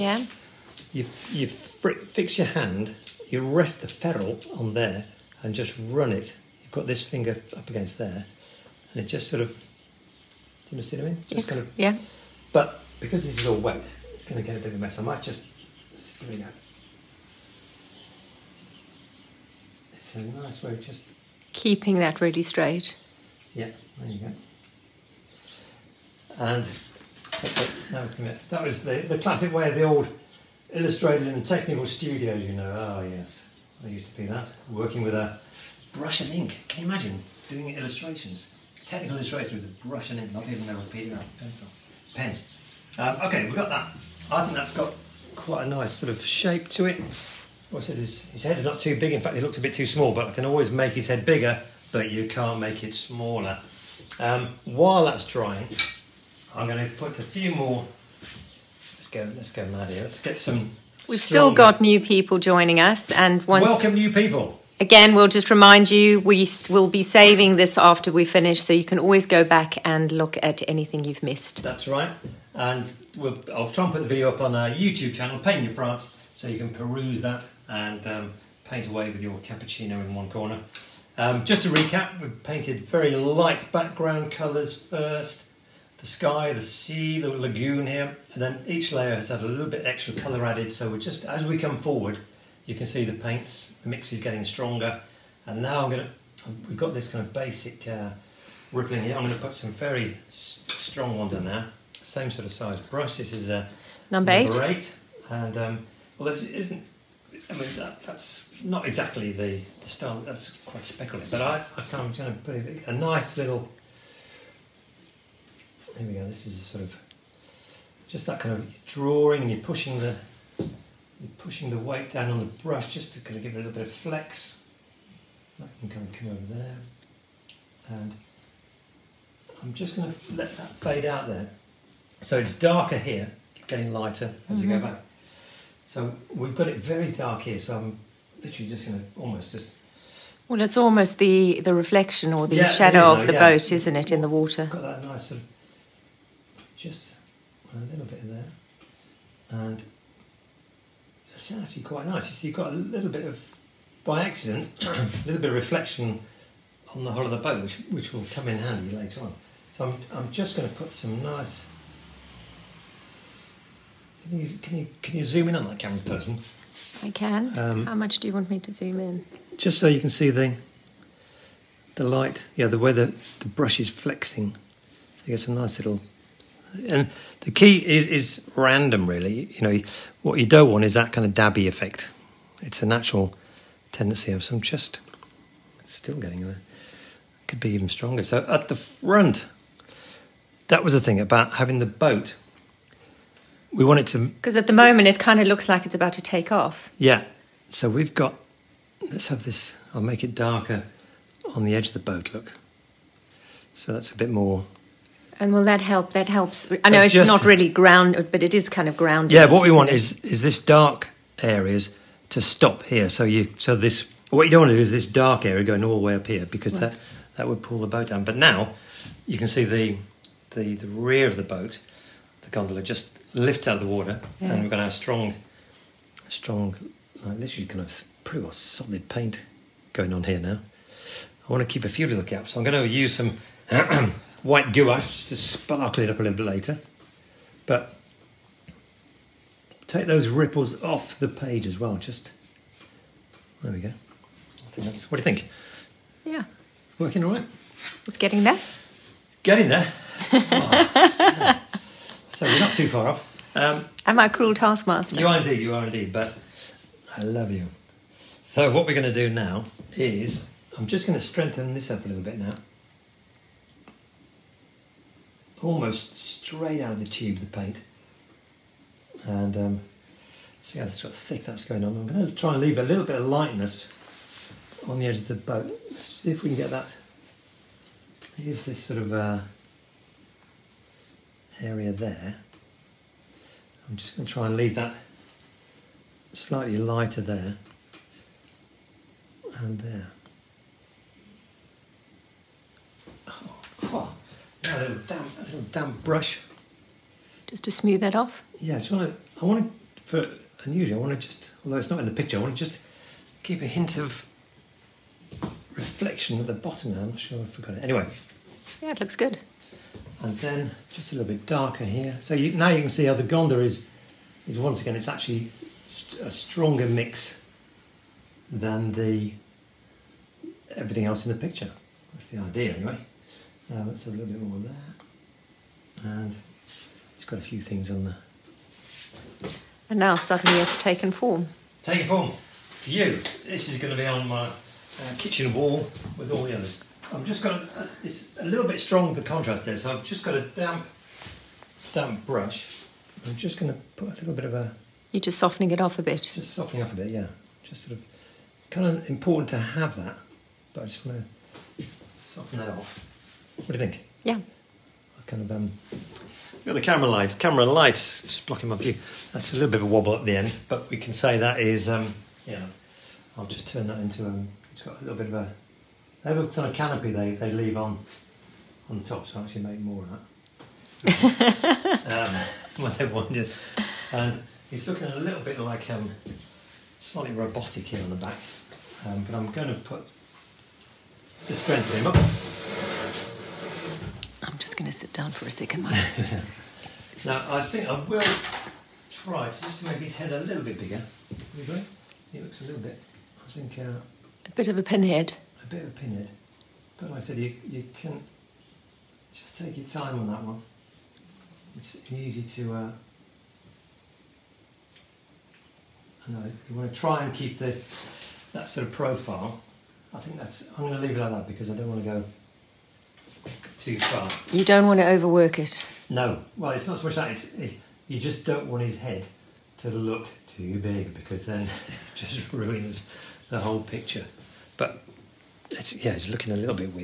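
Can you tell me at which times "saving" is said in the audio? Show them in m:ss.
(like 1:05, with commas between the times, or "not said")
1:07.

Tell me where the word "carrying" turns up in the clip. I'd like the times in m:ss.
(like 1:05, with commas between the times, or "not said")
not said.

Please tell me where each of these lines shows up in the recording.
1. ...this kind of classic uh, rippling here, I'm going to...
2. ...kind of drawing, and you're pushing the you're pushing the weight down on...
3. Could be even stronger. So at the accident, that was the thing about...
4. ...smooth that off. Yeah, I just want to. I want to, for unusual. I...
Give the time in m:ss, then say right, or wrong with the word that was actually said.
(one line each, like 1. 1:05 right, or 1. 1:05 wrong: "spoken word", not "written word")
1. 1:36 wrong: "basic", not "classic"
2. 1:58 right
3. 3:07 wrong: "front", not "accident"
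4. 4:57 right.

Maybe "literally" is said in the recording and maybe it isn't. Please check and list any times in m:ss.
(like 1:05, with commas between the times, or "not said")
2:18, 3:47.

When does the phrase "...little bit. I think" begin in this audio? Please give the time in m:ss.
6:32.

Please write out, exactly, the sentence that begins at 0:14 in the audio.
I might just, just give it a It's a nice way of just...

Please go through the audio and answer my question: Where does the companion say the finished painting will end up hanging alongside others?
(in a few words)
kitchen wall.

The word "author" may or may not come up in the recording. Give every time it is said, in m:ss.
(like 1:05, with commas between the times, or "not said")
not said.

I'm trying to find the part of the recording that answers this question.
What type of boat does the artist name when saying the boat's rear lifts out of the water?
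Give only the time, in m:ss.
3:42.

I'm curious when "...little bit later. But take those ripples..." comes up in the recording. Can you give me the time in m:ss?
3:56.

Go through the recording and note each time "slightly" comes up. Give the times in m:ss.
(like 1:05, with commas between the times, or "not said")
4:46, 6:16.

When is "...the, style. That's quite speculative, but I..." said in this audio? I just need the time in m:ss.
1:49.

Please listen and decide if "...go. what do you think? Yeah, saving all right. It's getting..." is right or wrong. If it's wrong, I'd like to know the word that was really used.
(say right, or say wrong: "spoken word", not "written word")
wrong: "working", not "saving".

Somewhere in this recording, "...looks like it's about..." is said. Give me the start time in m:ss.
3:15.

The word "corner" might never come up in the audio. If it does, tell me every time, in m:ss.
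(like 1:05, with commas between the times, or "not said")
1:20.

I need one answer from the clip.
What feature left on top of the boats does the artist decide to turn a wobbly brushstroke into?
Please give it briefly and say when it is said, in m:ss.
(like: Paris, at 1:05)
canopy, at 6:06.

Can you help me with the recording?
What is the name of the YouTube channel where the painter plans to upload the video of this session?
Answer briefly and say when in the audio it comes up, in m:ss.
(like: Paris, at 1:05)
Painting in France, at 1:15.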